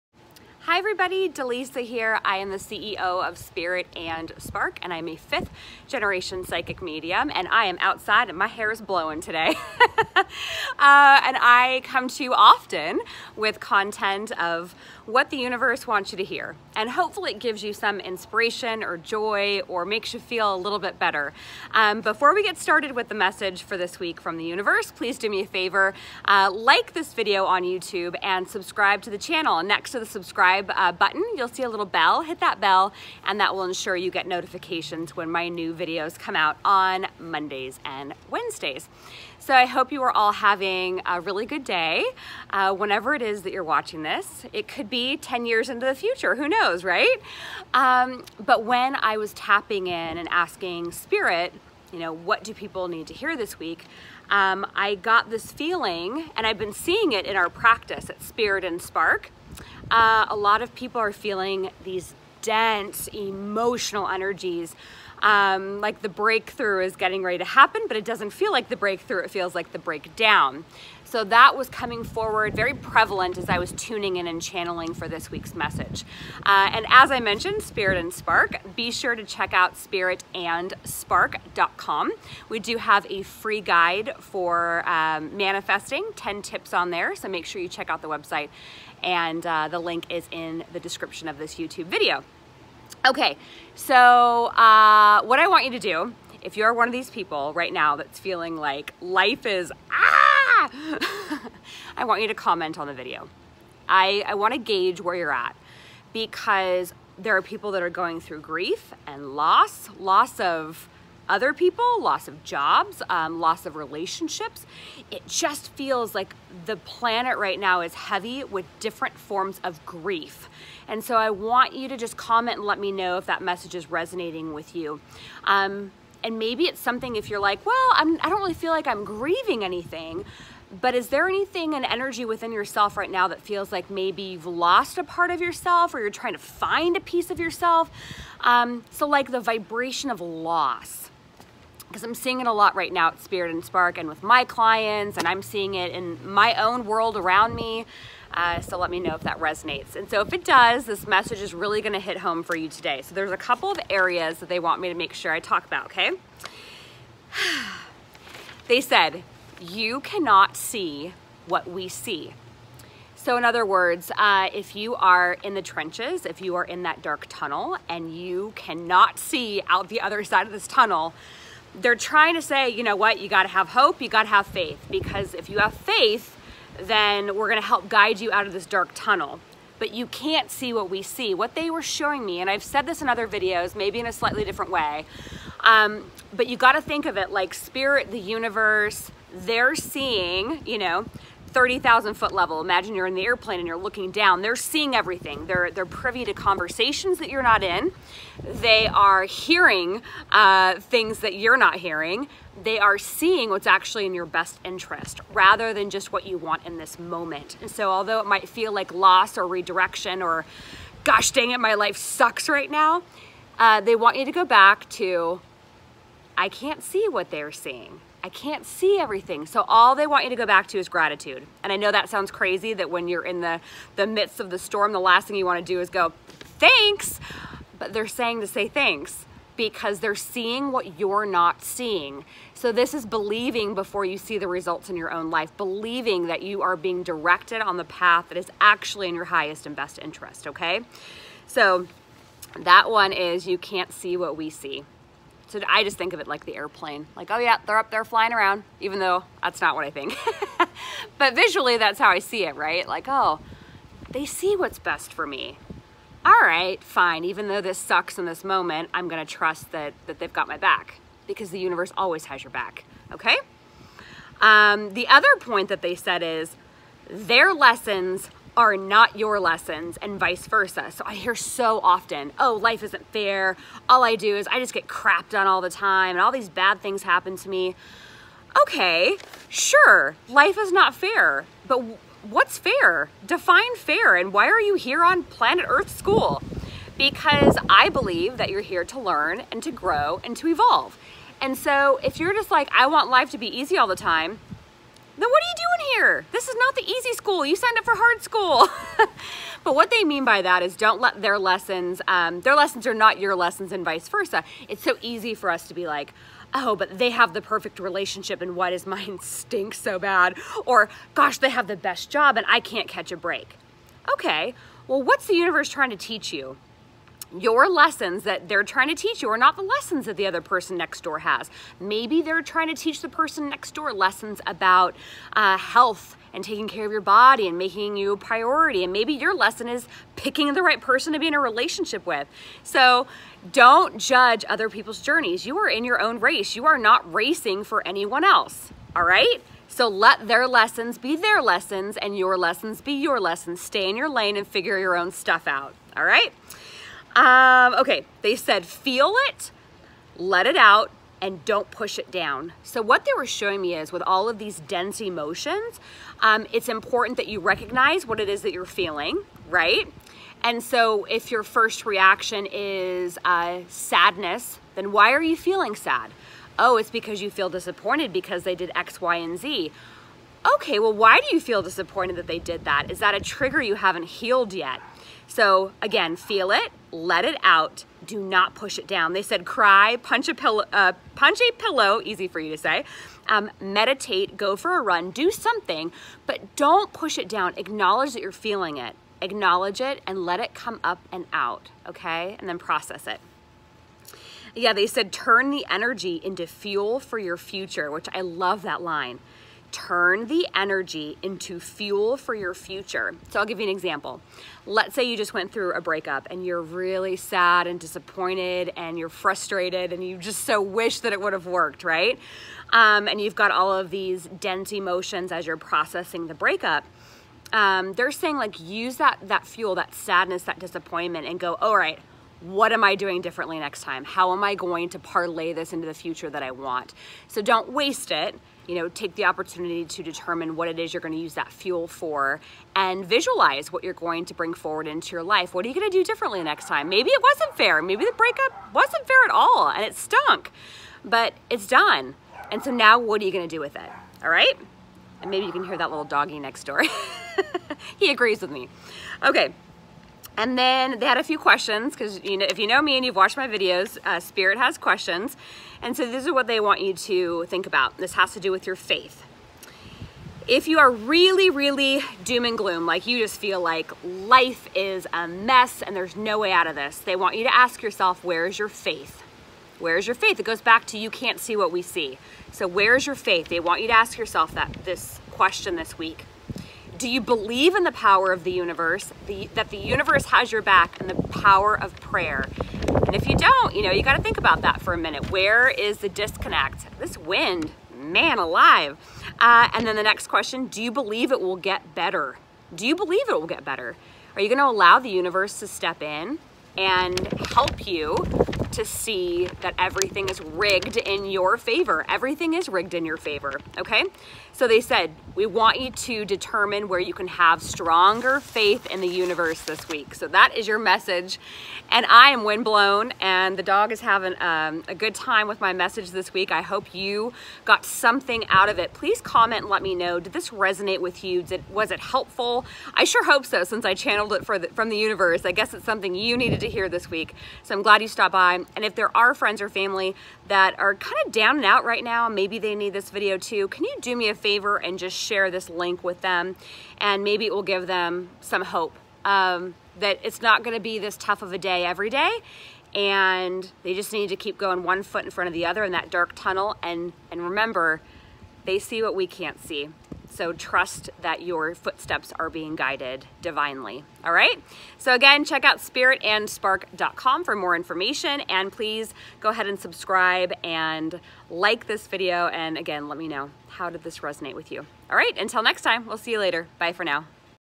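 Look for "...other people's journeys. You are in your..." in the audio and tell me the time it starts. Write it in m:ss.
5:34.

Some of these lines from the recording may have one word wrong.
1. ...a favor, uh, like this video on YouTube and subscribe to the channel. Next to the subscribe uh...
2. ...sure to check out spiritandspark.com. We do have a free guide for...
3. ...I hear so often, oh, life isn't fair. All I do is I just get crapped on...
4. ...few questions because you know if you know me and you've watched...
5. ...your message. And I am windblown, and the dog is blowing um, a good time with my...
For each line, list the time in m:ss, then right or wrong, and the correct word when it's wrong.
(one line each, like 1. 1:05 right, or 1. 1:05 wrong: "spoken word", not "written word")
1. 0:25 right
2. 1:18 right
3. 4:31 right
4. 7:31 right
5. 8:30 wrong: "having", not "blowing".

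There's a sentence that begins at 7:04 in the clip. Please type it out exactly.
How am I going to parlay this into the future that I want?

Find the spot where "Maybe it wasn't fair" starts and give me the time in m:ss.
7:16.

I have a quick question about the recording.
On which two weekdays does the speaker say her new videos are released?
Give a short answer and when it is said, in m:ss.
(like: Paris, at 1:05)
Mondays and Wednesdays, at 0:37.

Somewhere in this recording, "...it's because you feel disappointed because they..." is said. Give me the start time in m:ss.
6:06.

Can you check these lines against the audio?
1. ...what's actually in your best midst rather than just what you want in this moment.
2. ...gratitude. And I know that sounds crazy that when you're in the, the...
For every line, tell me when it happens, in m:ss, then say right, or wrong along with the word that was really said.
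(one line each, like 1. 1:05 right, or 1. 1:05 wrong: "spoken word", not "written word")
1. 3:23 wrong: "interest", not "midst"
2. 3:40 right.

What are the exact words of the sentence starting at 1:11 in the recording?
So that was coming forward very prevalent as I was tuning in and channeling for this week's message.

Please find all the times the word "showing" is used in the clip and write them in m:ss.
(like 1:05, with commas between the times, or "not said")
3:01, 5:53.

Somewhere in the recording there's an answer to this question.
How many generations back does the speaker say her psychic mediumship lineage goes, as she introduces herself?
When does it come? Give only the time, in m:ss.
0:05.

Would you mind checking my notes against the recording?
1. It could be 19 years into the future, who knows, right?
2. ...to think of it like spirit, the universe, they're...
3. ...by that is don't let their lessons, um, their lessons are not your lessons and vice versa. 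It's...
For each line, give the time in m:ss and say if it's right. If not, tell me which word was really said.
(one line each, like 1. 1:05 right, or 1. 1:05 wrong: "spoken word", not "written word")
1. 0:44 wrong: "10", not "19"
2. 3:06 right
3. 5:00 right.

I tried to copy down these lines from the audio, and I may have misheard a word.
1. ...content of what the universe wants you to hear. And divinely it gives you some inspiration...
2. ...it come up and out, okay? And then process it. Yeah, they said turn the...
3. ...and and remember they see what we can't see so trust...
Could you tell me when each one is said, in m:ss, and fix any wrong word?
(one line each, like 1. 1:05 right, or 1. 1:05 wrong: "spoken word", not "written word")
1. 0:13 wrong: "hopefully", not "divinely"
2. 6:30 right
3. 9:06 right.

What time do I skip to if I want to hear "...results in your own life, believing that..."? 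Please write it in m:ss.
3:54.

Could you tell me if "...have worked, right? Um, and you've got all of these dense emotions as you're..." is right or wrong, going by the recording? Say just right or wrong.
right.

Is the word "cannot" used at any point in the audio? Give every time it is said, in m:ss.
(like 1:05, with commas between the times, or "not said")
2:39, 2:48.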